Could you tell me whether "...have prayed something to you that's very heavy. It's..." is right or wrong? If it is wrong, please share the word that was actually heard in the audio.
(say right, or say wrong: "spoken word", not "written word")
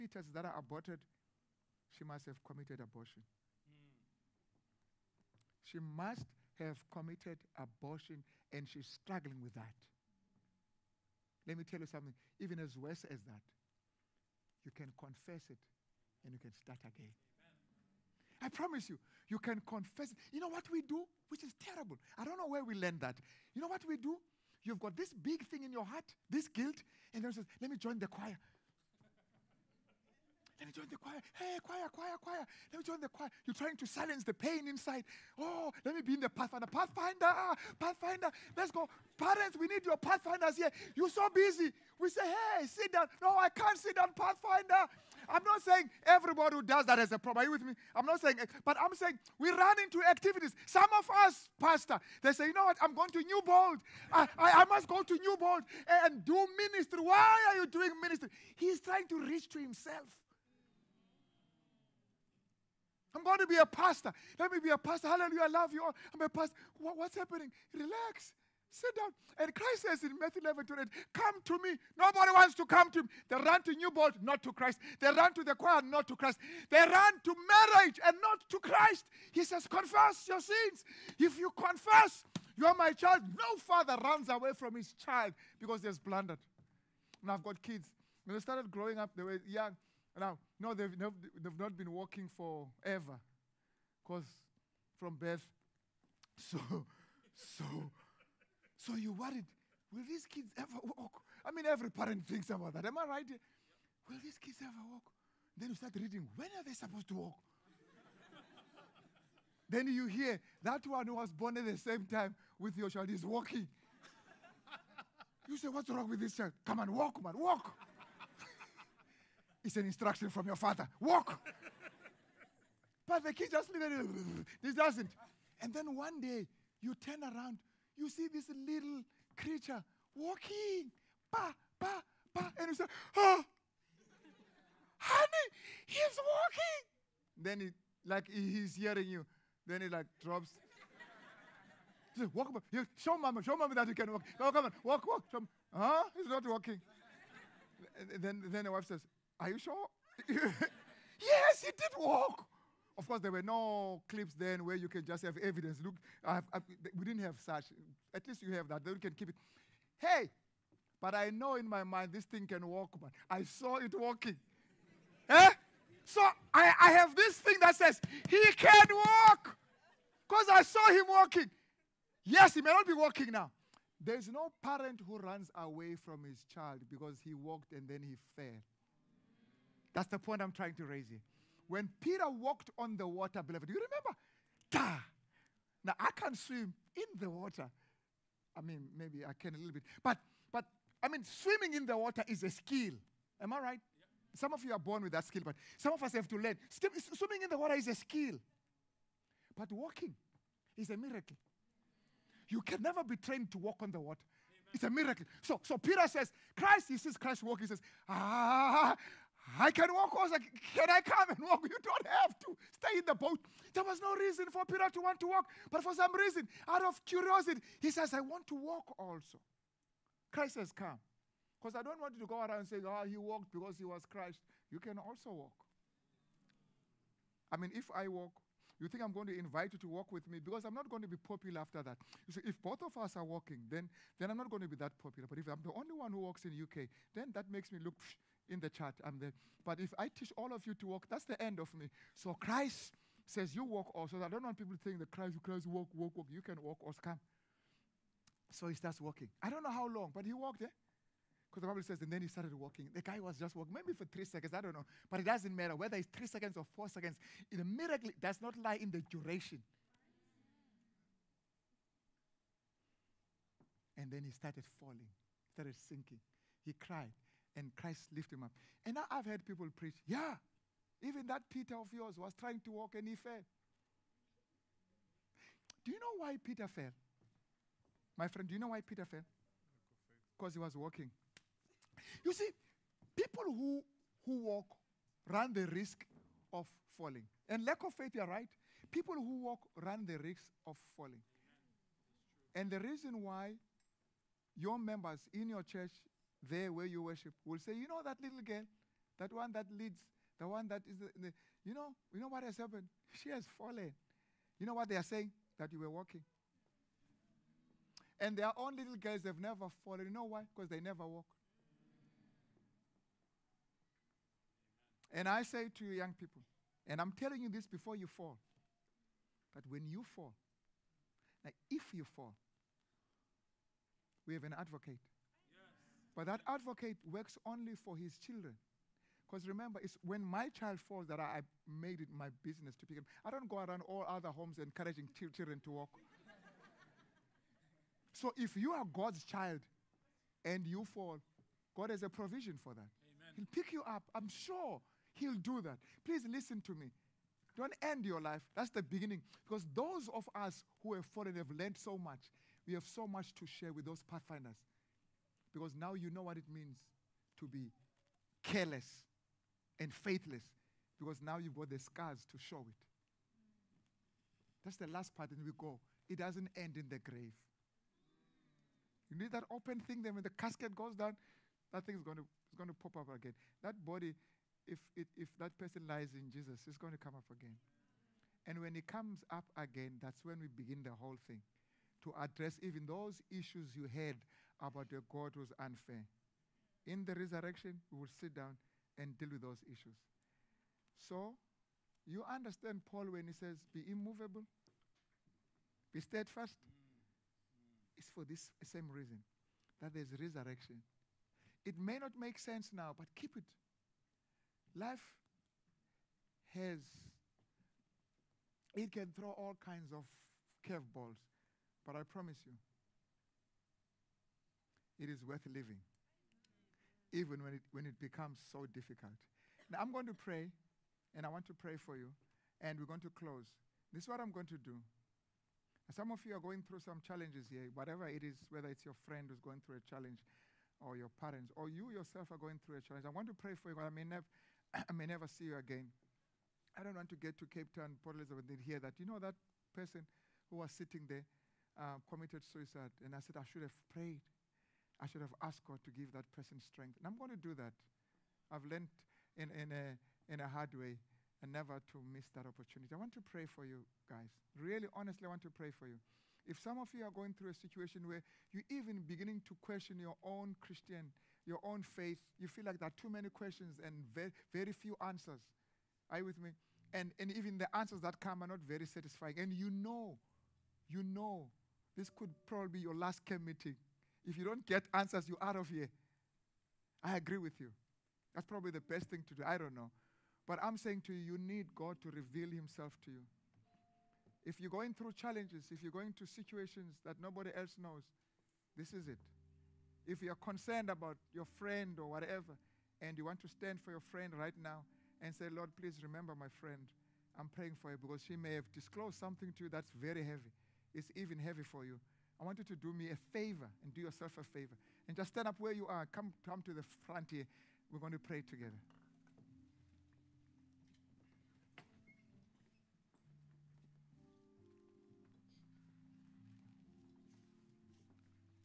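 wrong: "disclosed", not "prayed".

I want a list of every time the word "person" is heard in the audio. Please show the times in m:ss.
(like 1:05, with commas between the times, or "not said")
6:15, 7:19, 7:26.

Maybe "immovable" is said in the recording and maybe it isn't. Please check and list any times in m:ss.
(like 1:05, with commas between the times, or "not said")
6:33.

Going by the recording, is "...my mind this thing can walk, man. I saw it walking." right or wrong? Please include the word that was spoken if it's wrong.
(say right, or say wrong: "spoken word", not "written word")
right.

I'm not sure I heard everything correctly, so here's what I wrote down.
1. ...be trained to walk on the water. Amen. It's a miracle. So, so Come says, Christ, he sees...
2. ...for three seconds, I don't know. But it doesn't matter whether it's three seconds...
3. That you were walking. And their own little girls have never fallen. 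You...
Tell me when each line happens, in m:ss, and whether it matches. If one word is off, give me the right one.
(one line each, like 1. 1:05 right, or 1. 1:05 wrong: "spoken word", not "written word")
1. 3:23 wrong: "Peter", not "Come"
2. 4:13 right
3. 5:05 right.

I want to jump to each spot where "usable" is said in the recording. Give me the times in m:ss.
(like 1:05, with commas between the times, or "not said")
not said.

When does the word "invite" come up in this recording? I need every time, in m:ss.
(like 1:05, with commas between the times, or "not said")
3:49.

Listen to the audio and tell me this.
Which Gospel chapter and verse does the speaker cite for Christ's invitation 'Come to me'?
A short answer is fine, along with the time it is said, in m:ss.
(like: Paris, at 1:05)
Matthew 11 8, at 1:10.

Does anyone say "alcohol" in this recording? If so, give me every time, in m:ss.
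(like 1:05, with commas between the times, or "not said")
not said.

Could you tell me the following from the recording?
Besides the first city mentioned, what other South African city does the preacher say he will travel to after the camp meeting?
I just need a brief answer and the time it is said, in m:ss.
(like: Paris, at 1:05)
Port Elizabeth, at 7:18.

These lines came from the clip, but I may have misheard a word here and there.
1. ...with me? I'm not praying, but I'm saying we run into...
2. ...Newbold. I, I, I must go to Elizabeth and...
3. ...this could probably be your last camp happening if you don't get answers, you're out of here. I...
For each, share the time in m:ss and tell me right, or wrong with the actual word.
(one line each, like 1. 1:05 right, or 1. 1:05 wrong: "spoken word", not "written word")
1. 0:47 wrong: "saying", not "praying"
2. 0:53 wrong: "Newbold", not "Elizabeth"
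3. 7:51 wrong: "meeting", not "happening".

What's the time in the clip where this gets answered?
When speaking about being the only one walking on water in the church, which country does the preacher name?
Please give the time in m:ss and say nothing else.
3:56.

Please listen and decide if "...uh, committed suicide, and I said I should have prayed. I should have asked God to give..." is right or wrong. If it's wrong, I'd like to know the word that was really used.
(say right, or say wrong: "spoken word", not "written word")
right.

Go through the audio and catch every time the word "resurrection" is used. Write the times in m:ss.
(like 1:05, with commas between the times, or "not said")
6:27, 6:40.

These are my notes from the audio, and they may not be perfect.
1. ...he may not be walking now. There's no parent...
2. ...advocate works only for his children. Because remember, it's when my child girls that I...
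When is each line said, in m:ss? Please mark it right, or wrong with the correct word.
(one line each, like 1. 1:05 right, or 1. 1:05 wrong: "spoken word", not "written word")
1. 2:52 right
2. 5:26 wrong: "falls", not "girls".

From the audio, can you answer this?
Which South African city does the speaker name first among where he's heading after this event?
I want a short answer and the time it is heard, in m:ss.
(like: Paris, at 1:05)
Cape Town, at 7:17.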